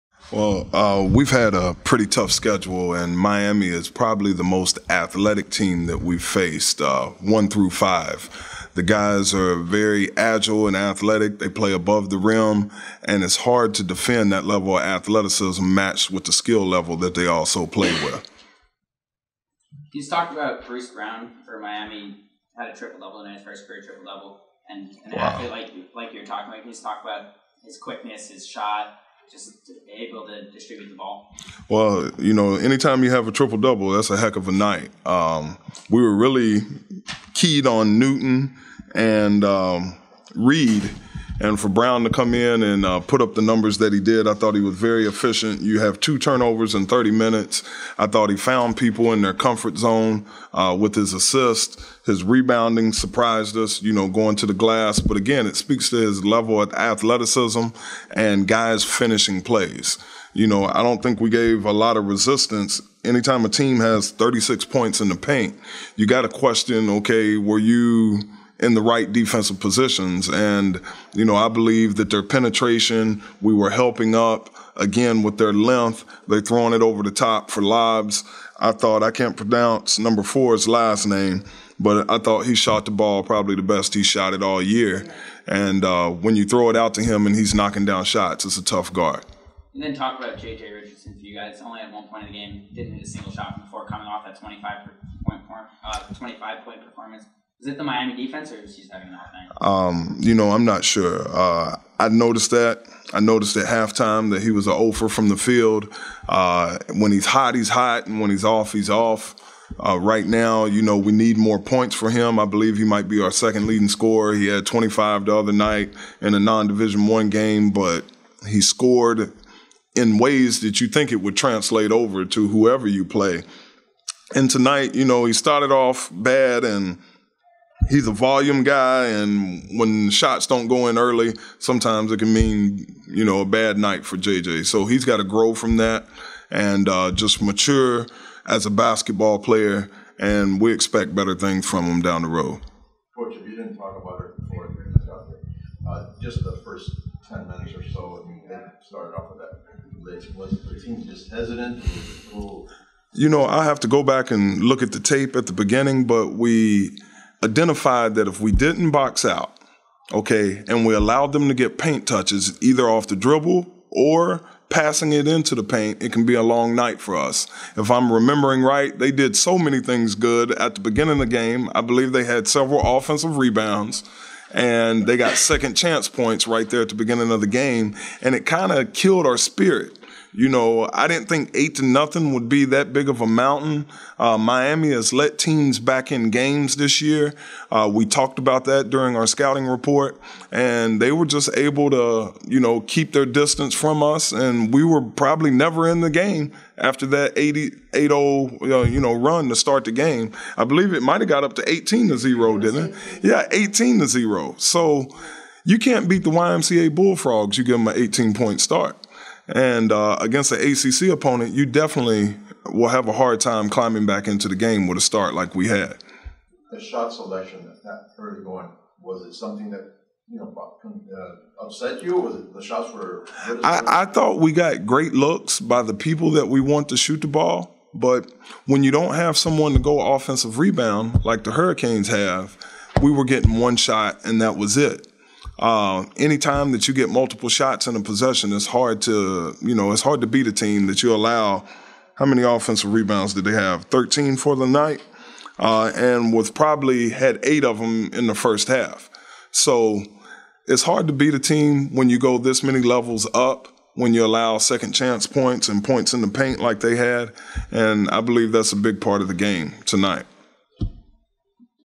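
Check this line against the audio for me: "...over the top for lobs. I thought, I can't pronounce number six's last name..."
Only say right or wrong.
wrong.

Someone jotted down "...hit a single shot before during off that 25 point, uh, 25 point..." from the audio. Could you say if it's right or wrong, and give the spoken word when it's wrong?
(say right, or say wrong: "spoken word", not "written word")
wrong: "coming", not "during".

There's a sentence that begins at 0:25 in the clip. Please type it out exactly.
athlete like like you're talking about.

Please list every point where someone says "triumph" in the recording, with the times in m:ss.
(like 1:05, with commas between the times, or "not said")
not said.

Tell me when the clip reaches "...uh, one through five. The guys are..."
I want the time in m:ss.
0:06.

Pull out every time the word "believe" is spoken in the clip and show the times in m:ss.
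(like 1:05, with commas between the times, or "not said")
1:11, 1:52, 2:51, 3:20, 4:18.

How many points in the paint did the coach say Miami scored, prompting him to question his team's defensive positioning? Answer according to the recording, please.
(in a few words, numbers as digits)
36.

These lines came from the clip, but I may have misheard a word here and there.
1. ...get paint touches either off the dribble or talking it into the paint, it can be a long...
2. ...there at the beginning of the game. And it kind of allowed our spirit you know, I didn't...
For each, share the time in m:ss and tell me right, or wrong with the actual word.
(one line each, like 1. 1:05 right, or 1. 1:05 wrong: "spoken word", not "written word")
1. 2:41 wrong: "passing", not "talking"
2. 2:56 wrong: "killed", not "allowed".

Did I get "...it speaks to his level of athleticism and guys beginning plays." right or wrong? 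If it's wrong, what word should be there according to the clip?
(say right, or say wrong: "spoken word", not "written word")
wrong: "finishing", not "beginning".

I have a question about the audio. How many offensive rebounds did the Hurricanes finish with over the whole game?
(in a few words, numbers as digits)
13.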